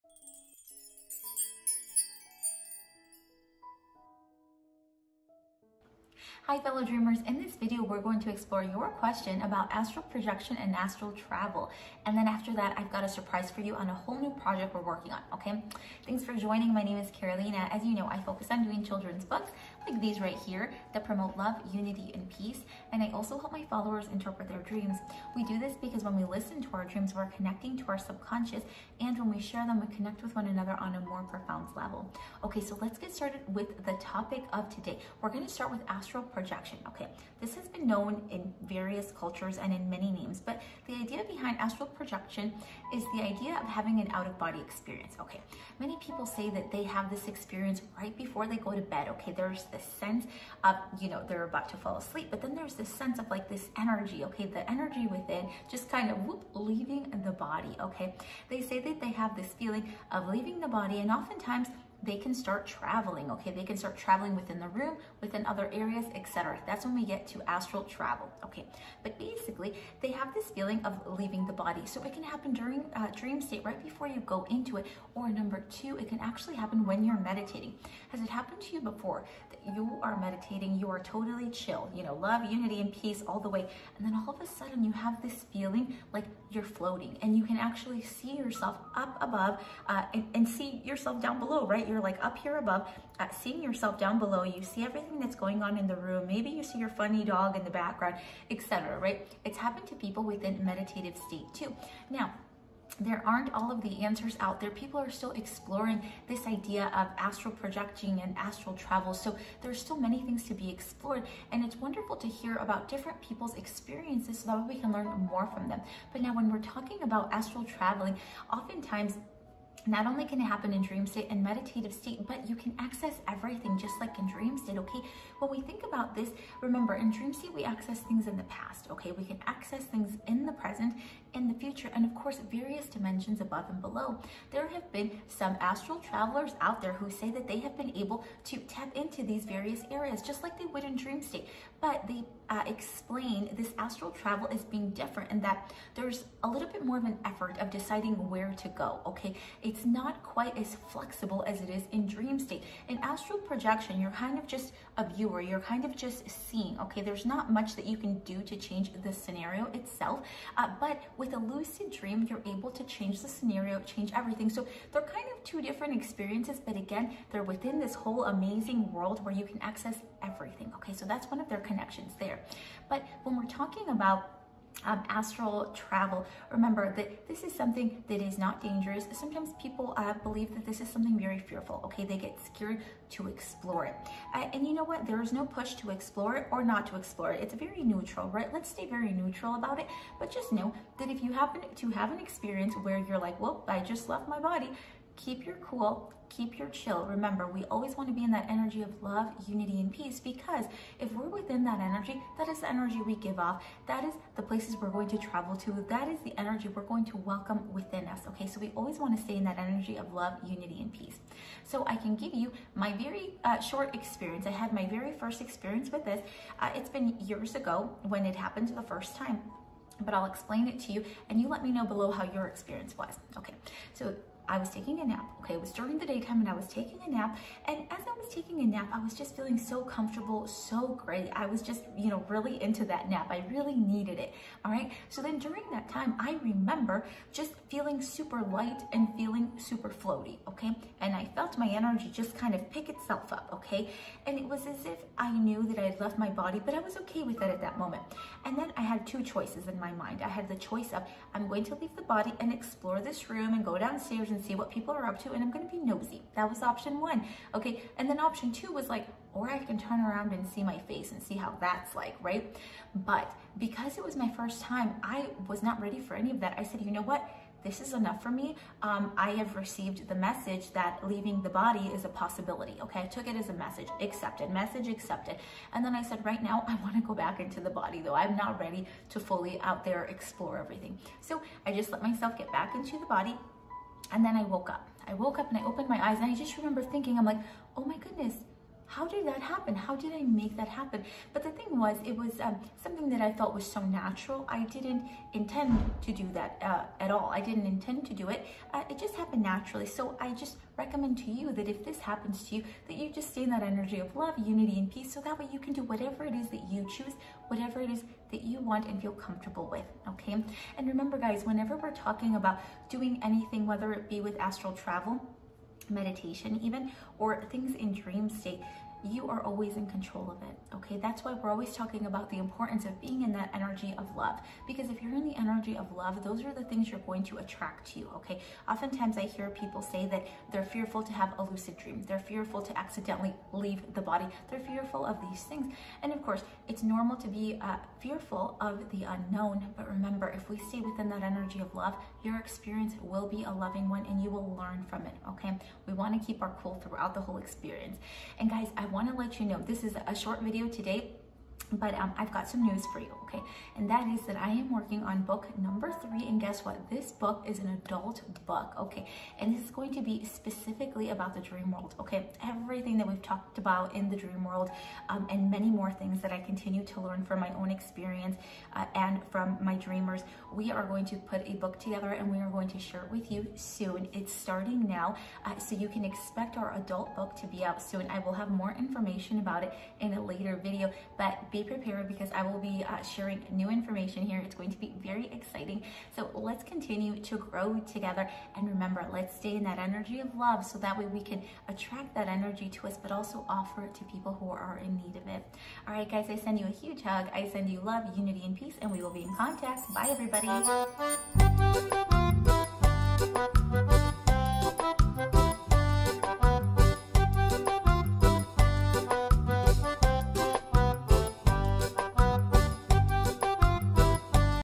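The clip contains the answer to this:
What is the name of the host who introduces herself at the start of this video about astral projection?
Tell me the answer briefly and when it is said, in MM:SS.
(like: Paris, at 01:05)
Carolina, at 00:17.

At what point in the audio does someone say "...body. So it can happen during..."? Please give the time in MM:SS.
01:11.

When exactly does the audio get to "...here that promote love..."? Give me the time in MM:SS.
00:20.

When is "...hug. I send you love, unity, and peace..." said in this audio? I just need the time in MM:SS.
06:37.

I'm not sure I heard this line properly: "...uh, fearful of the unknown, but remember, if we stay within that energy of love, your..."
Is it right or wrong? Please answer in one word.
right.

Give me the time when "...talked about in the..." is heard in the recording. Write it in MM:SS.
06:03.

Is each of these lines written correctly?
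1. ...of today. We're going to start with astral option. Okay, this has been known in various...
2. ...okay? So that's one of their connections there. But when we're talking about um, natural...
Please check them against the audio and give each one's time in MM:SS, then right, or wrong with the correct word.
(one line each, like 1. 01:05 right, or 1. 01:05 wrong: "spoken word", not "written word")
1. 00:34 wrong: "projection", not "option"
2. 02:50 wrong: "astral", not "natural".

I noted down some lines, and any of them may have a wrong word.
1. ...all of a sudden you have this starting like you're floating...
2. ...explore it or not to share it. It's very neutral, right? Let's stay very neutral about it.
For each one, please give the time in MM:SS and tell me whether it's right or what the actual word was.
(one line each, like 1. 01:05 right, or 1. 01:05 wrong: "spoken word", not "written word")
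1. 01:24 wrong: "feeling", not "starting"
2. 03:05 wrong: "explore", not "share".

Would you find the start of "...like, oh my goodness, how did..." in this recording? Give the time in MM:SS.
04:47.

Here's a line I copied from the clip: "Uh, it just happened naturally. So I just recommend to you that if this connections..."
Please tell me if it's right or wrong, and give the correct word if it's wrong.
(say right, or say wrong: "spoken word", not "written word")
wrong: "happens", not "connections".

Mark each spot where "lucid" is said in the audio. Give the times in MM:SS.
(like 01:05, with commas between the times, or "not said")
02:41, 05:31.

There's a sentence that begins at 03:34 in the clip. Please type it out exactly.
I had my very first experience with this.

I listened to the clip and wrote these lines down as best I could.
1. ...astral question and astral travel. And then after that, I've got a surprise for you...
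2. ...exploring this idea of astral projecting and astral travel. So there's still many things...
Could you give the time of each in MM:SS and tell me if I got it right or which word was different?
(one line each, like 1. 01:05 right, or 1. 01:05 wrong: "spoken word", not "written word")
1. 00:09 wrong: "projection", not "question"
2. 01:45 right.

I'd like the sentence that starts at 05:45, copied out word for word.
Okay, we want to keep our cool throughout the whole experience.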